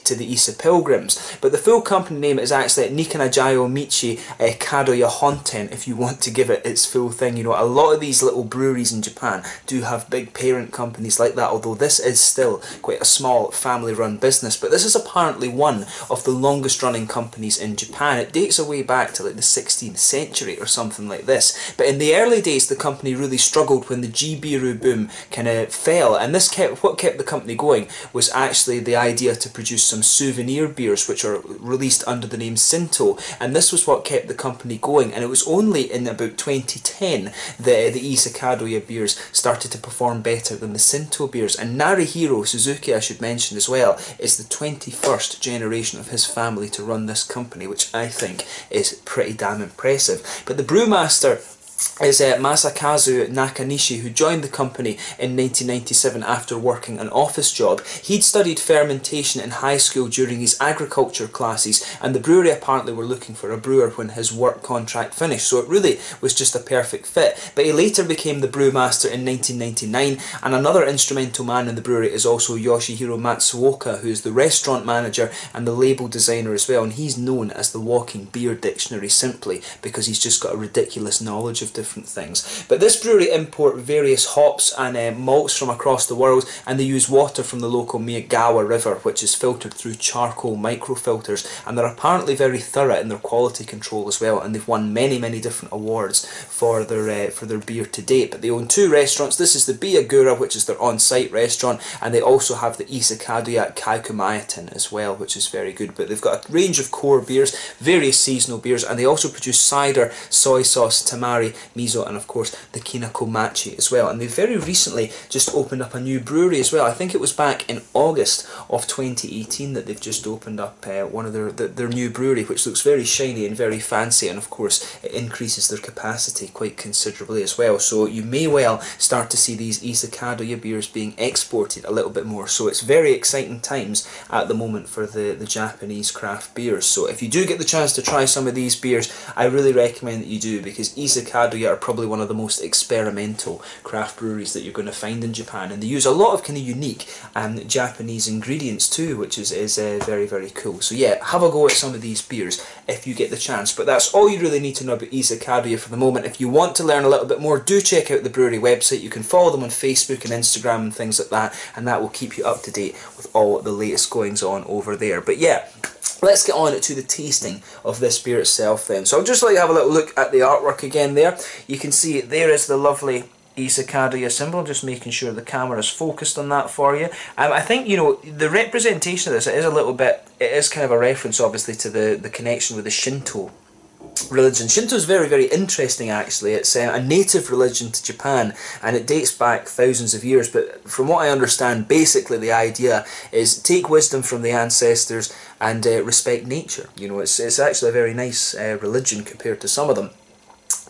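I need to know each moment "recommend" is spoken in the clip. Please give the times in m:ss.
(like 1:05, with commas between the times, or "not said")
2:19.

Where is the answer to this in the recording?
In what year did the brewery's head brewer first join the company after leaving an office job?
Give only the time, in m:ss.
0:55.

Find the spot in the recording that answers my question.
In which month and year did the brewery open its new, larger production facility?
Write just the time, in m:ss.
1:57.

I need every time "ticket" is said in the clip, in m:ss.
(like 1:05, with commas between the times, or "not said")
not said.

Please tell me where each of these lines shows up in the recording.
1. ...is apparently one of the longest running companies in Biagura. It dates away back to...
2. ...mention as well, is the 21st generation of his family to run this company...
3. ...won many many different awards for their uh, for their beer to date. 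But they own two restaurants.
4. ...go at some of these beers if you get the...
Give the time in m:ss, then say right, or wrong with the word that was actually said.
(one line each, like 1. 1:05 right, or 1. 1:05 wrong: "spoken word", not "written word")
1. 0:14 wrong: "Japan", not "Biagura"
2. 0:43 right
3. 1:34 right
4. 2:31 right.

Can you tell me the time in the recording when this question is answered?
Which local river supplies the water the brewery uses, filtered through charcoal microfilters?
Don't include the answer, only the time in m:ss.
1:27.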